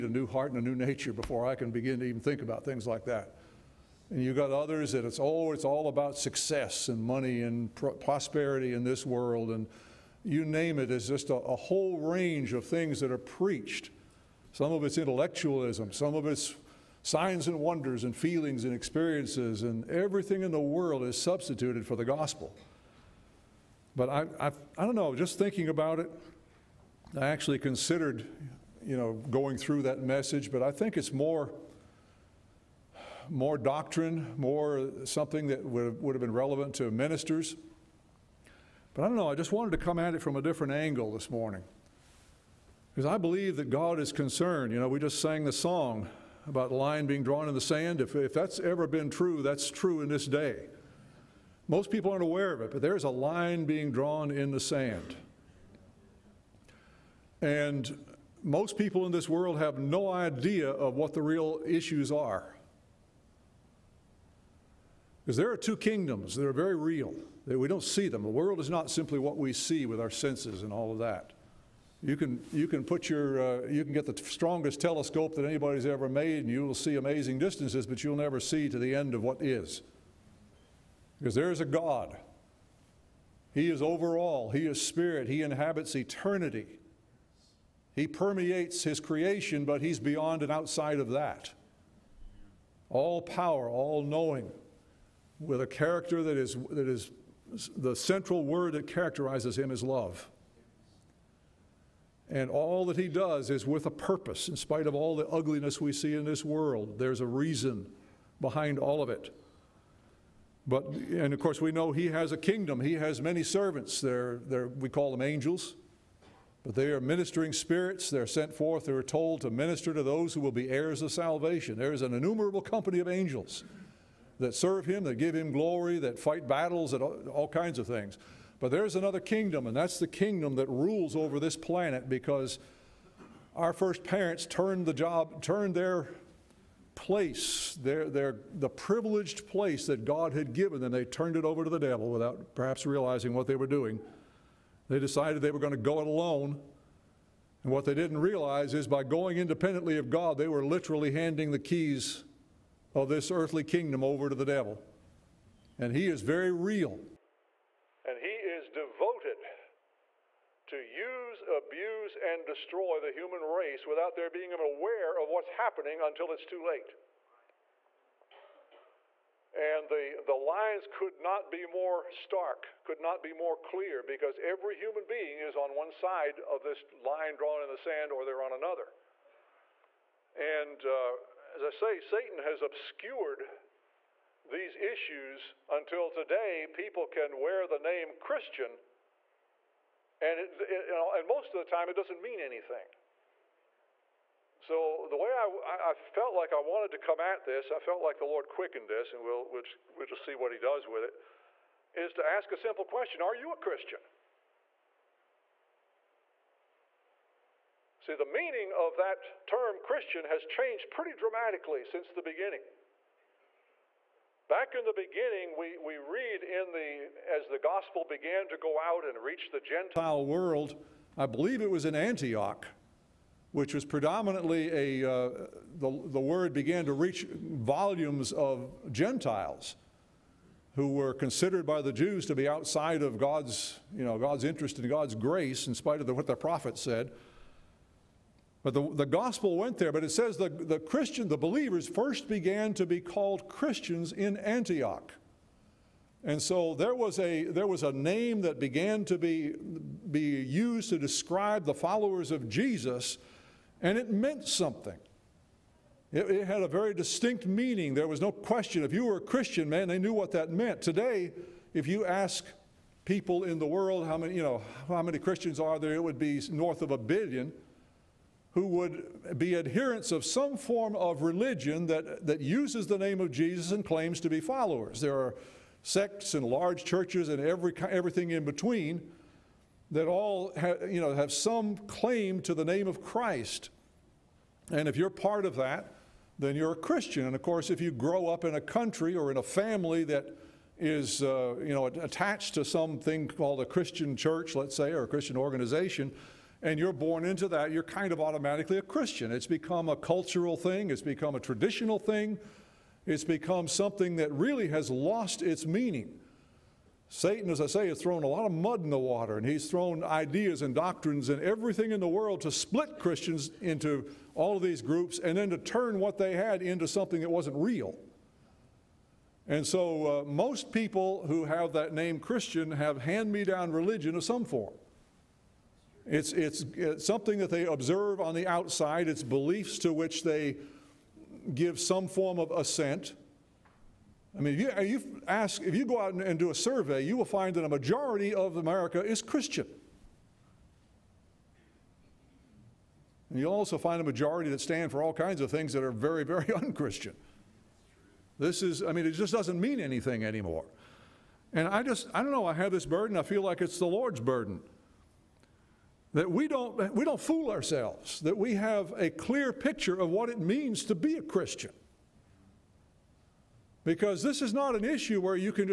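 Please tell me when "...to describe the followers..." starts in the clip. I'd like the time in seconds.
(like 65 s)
250 s.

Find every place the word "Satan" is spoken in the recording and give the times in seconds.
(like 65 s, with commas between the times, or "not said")
181 s, 307 s.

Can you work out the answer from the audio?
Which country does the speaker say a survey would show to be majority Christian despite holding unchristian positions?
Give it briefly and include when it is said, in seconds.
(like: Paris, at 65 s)
America, at 338 s.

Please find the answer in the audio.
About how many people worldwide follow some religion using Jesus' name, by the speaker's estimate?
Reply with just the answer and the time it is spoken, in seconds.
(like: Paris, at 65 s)
North of a billion, at 266 s.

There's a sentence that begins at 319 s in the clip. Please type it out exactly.
And so, uh, most people who have that name Christian have hand me down religion of some form.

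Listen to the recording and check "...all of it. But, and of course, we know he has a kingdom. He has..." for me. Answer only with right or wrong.
right.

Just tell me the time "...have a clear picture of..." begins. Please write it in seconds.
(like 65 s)
358 s.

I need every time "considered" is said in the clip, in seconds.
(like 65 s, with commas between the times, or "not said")
27 s, 231 s.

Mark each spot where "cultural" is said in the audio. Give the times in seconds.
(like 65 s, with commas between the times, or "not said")
299 s.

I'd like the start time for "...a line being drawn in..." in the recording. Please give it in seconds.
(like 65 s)
53 s.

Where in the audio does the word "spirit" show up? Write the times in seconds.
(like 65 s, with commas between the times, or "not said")
84 s, 117 s.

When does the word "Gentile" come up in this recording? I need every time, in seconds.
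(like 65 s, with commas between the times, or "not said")
219 s, 228 s.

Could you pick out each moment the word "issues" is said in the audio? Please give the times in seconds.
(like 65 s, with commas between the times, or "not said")
61 s, 184 s, 364 s.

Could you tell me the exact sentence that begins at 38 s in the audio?
But I don't know, I just wanted to come at it from a different angle this morning.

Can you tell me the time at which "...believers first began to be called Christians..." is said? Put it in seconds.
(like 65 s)
241 s.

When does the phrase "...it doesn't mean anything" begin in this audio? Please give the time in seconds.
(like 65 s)
191 s.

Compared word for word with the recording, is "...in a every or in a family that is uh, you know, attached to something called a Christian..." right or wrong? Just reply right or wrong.
wrong.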